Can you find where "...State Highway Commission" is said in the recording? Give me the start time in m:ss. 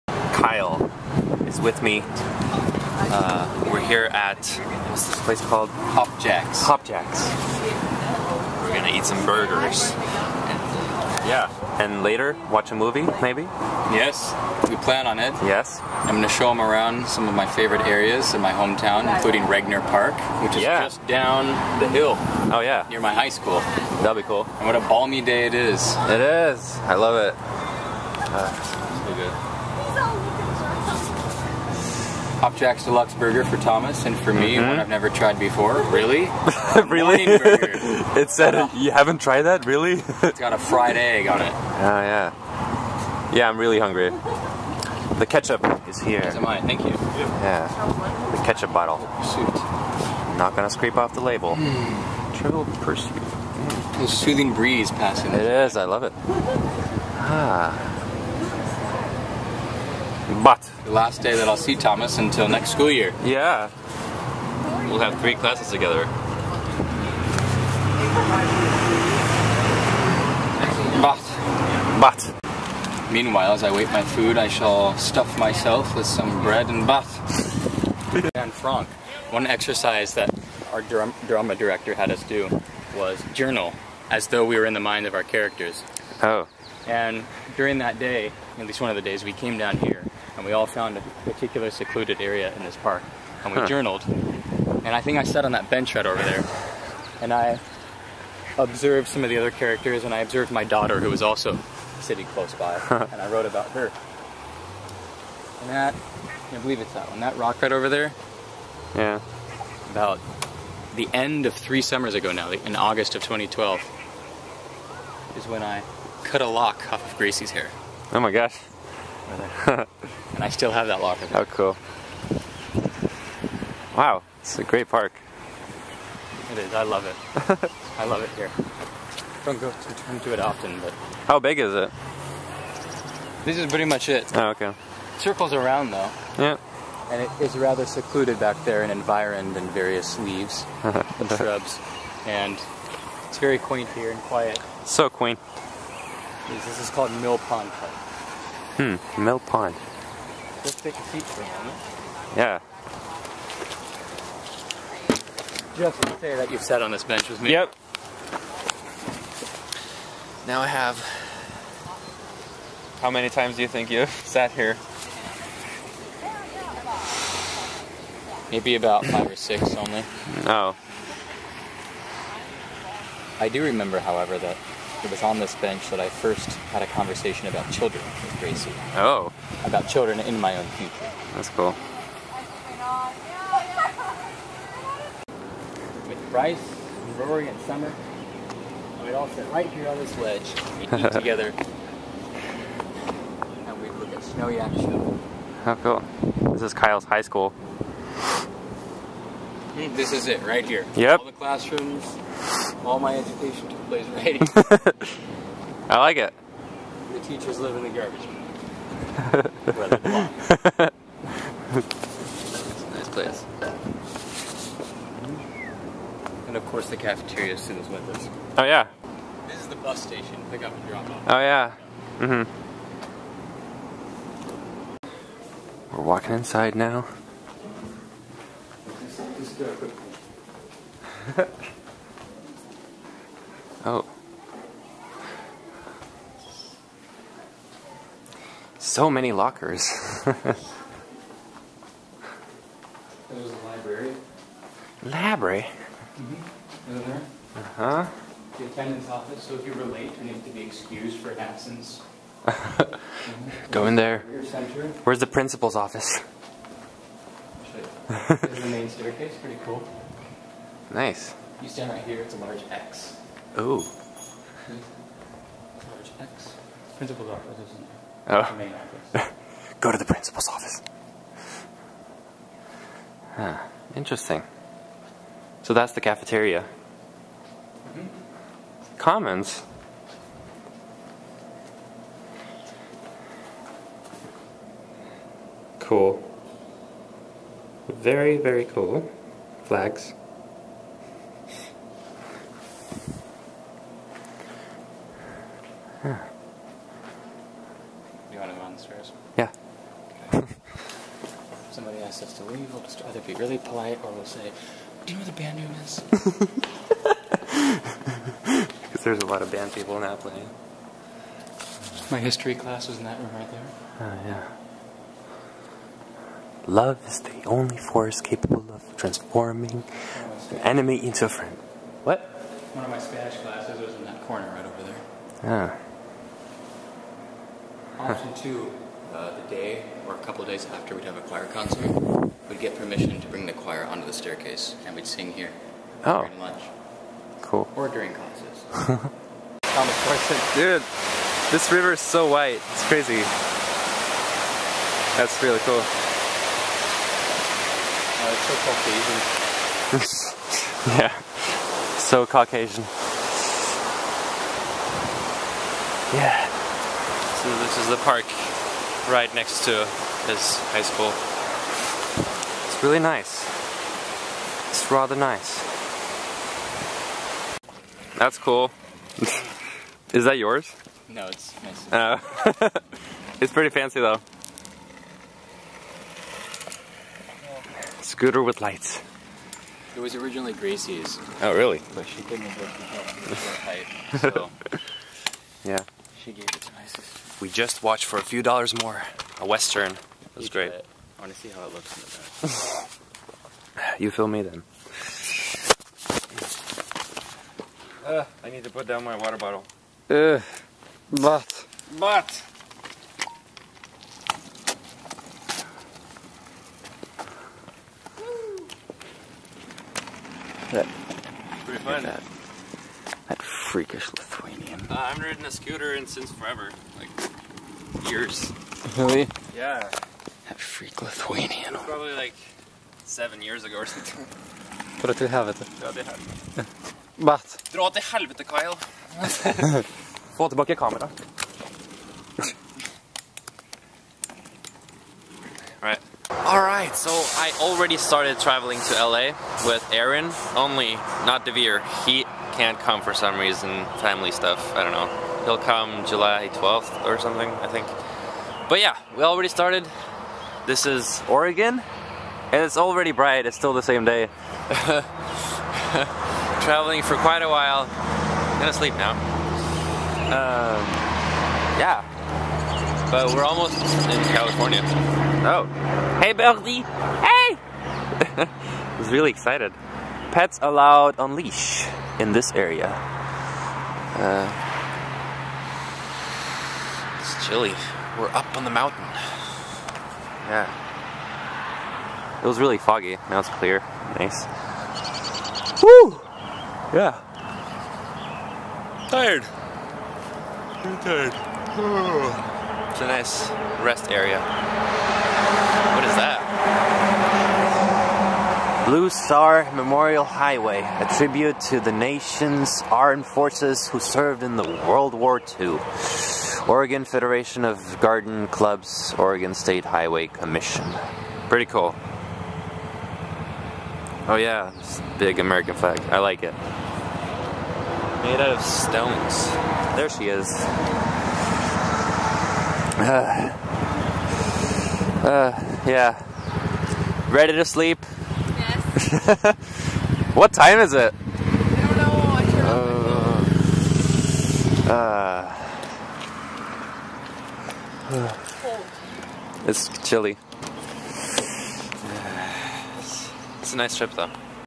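8:29.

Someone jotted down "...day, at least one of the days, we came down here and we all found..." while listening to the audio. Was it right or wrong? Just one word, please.
right.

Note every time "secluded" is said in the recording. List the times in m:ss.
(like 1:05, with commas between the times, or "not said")
1:31, 2:17.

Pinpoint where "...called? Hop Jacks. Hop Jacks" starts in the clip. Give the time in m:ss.
0:05.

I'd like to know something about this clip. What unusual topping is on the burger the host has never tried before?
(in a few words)
A fried egg.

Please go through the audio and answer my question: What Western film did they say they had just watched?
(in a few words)
For a Few Dollars More.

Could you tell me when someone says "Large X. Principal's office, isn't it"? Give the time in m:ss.
4:25.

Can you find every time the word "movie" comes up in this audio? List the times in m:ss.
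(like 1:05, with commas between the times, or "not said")
0:12.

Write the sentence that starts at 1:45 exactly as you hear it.
And that, I believe it's that one, that rock right over there.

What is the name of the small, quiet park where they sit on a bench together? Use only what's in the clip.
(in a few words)
Mill Pond Park.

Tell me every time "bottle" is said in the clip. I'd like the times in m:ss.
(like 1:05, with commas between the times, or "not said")
0:48, 6:39.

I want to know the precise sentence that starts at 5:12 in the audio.
My history class was in that room right there.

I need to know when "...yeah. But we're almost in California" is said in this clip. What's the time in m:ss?
7:41.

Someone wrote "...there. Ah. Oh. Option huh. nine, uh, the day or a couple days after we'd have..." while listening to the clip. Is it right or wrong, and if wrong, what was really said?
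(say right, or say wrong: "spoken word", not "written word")
wrong: "two", not "nine".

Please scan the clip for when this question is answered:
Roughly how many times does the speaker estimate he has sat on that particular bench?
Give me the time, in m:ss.
2:49.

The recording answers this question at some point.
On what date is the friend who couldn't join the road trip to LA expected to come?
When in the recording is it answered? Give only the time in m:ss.
7:26.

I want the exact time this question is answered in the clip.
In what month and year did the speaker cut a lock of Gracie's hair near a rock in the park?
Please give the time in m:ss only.
1:52.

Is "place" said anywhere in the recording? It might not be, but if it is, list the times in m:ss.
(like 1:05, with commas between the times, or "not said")
0:05, 3:23, 3:33.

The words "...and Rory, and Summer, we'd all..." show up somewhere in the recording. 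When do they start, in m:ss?
3:07.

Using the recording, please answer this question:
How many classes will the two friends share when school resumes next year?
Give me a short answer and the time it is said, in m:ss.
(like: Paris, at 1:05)
3, at 1:05.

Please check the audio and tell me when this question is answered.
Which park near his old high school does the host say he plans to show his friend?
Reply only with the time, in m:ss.
0:19.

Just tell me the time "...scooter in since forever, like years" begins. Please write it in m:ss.
6:55.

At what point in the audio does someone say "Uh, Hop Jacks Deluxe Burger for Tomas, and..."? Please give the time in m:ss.
0:28.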